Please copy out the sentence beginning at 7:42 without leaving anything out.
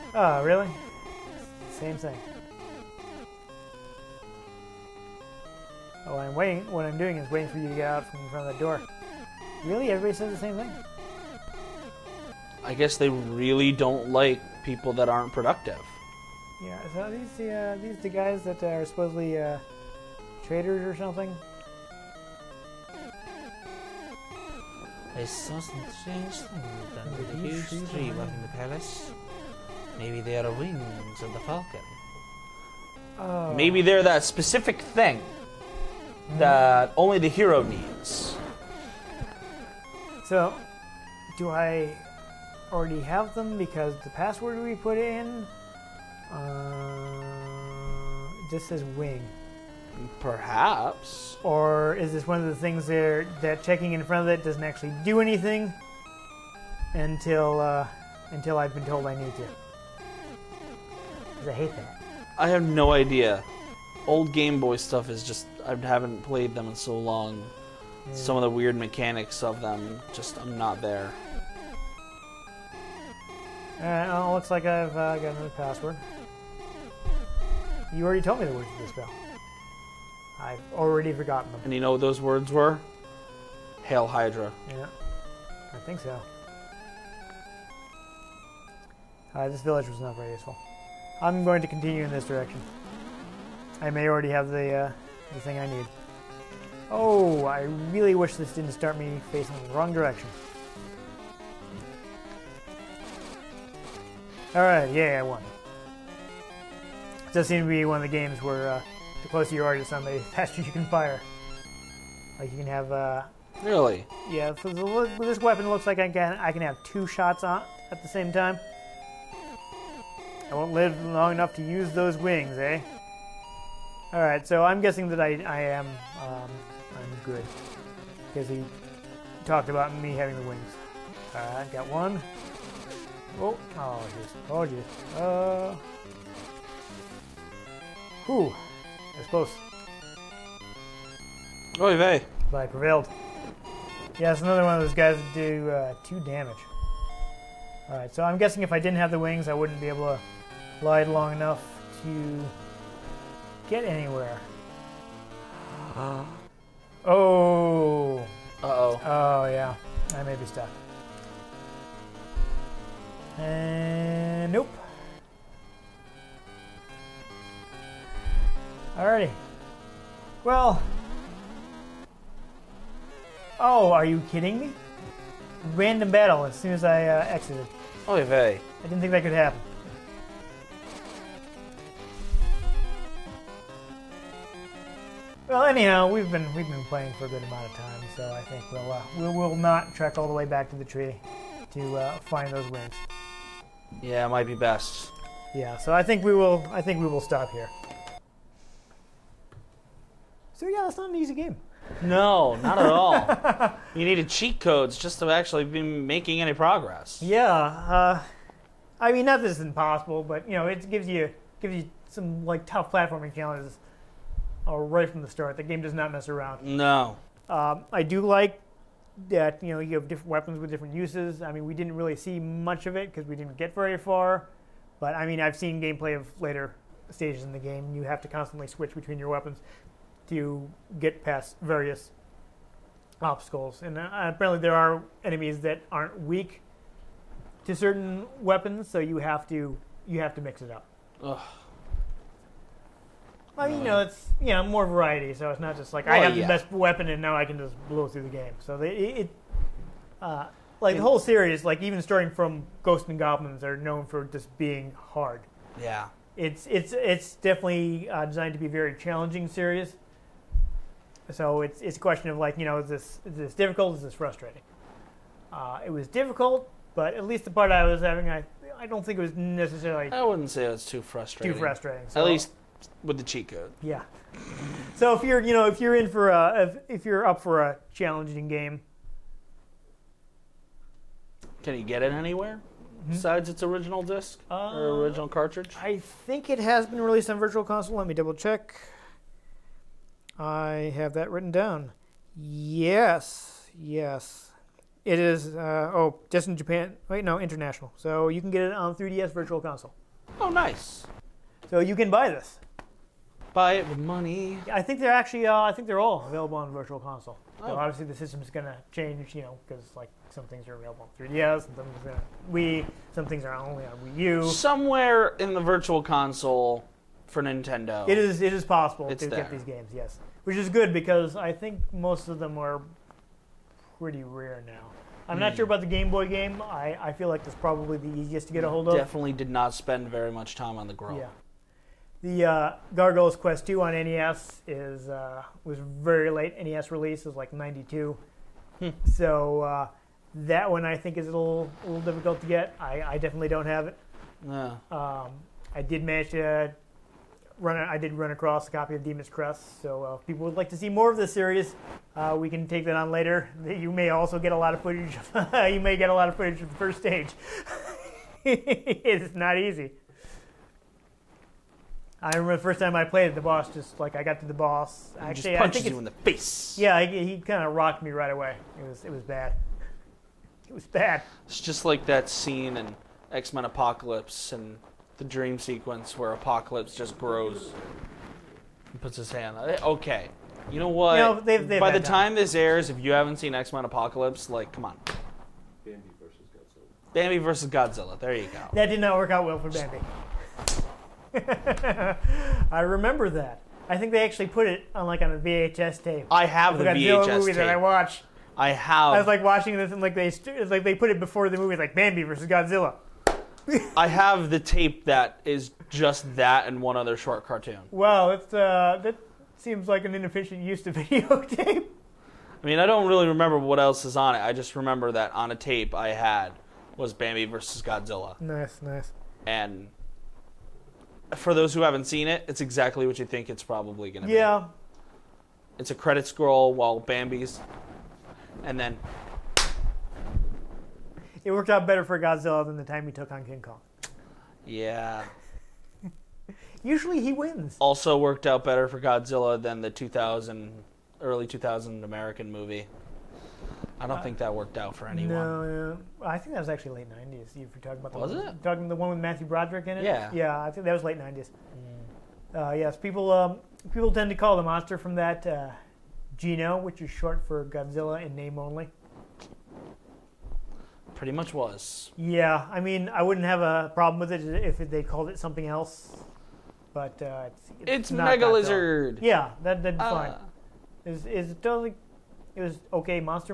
Yeah, I mean, I wouldn't have a problem with it if they called it something else.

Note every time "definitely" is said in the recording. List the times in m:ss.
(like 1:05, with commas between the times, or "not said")
4:17, 5:28, 5:43.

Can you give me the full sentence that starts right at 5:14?
Somewhere in the Virtual Console for Nintendo.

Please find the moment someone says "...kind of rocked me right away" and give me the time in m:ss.
6:07.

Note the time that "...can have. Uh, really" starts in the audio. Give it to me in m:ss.
1:52.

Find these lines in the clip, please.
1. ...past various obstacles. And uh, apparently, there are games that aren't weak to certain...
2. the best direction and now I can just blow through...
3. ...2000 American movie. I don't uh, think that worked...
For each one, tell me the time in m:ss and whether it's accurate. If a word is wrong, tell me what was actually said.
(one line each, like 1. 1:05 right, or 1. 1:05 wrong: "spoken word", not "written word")
1. 3:51 wrong: "enemies", not "games"
2. 4:06 wrong: "weapon", not "direction"
3. 7:21 right.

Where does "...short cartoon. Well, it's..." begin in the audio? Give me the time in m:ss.
6:47.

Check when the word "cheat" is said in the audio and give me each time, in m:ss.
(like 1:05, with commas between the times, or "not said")
3:24, 4:33.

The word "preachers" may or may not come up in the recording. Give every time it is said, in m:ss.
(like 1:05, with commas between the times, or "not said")
not said.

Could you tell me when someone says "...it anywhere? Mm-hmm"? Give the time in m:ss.
4:42.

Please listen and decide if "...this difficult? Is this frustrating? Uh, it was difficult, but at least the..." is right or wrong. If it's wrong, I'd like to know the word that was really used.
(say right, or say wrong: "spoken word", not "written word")
right.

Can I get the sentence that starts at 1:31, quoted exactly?
I'm going to continue in this direction.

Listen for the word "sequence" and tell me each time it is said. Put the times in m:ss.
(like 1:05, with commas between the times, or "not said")
6:15.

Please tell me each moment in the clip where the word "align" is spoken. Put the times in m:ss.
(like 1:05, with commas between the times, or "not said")
not said.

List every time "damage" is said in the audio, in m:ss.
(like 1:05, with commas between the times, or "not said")
2:26.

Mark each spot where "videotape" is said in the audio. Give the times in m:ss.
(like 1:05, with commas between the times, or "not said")
6:50.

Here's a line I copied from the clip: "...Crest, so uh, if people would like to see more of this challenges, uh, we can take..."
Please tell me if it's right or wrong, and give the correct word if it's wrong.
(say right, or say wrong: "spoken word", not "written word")
wrong: "series", not "challenges".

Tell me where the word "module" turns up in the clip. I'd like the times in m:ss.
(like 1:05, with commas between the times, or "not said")
not said.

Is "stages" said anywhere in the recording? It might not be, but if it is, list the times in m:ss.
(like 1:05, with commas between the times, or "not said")
3:47, 5:56.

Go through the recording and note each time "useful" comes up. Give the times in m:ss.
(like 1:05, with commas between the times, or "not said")
1:30.